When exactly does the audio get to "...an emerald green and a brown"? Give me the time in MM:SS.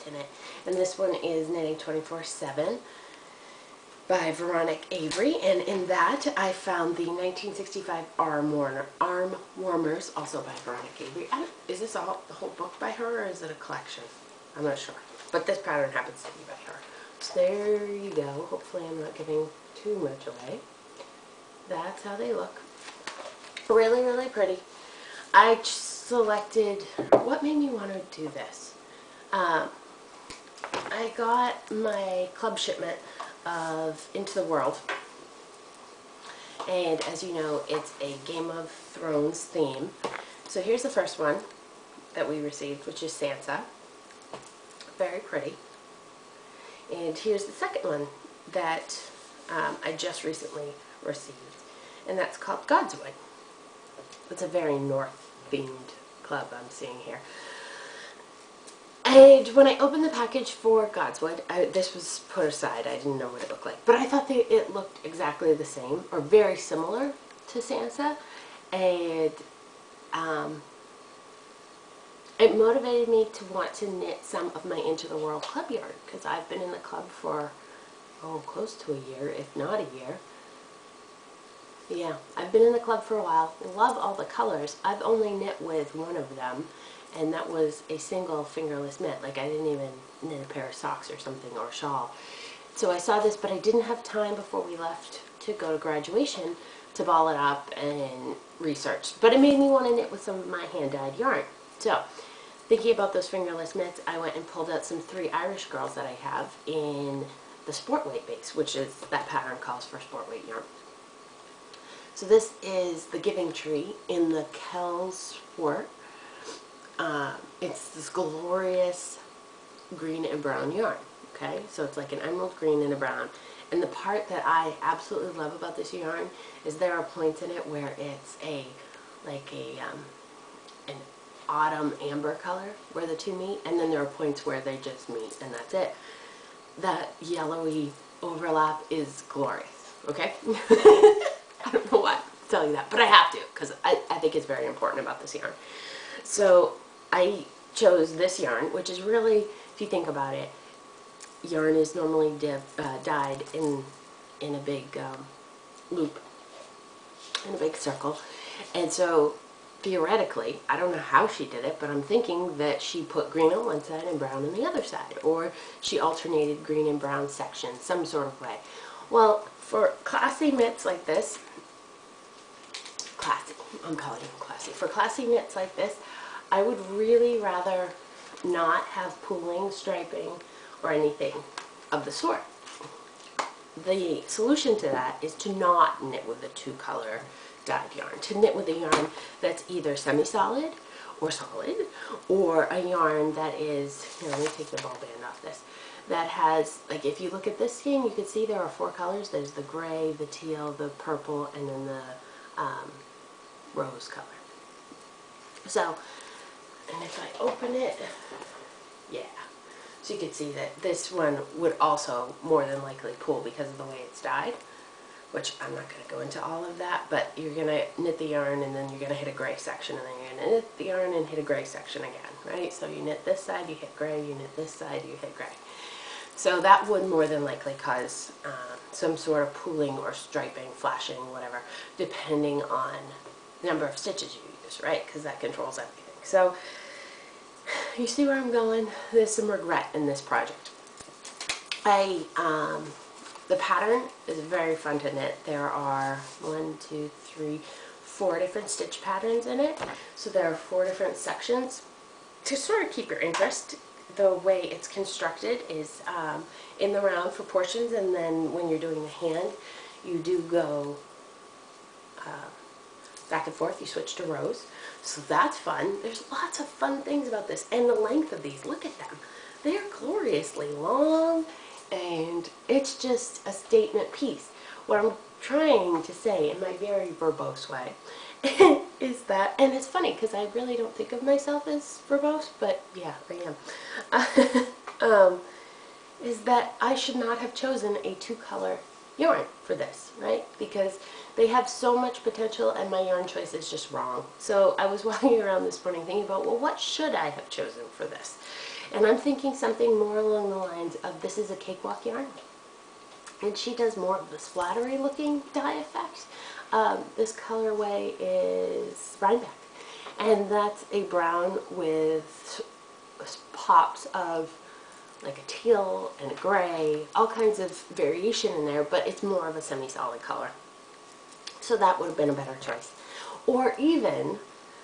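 02:02.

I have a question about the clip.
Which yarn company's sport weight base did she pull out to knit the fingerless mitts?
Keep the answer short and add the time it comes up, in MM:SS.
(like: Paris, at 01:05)
Three Irish Girls, at 01:45.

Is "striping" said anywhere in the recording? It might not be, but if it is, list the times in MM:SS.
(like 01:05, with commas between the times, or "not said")
02:59, 03:50.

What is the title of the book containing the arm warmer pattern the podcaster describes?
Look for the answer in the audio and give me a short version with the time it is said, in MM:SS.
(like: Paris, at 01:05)
Knitting 24-7, at 00:01.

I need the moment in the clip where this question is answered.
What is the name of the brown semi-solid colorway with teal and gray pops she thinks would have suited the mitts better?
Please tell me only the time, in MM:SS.
05:09.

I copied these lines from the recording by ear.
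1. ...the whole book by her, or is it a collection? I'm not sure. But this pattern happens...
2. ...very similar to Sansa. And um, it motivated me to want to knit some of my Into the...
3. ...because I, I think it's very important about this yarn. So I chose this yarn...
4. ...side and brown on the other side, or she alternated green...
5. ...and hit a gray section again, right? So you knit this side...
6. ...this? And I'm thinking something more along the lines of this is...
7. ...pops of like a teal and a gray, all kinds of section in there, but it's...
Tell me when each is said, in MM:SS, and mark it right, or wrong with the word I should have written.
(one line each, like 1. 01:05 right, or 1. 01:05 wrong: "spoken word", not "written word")
1. 00:12 right
2. 01:06 right
3. 02:23 right
4. 02:43 right
5. 03:41 right
6. 04:58 right
7. 05:13 wrong: "variation", not "section".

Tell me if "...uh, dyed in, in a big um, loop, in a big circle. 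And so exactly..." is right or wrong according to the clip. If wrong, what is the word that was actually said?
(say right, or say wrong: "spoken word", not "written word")
wrong: "theoretically", not "exactly".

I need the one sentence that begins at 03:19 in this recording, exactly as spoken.
There's the gray, the teal, the purple, and then the um, rose color.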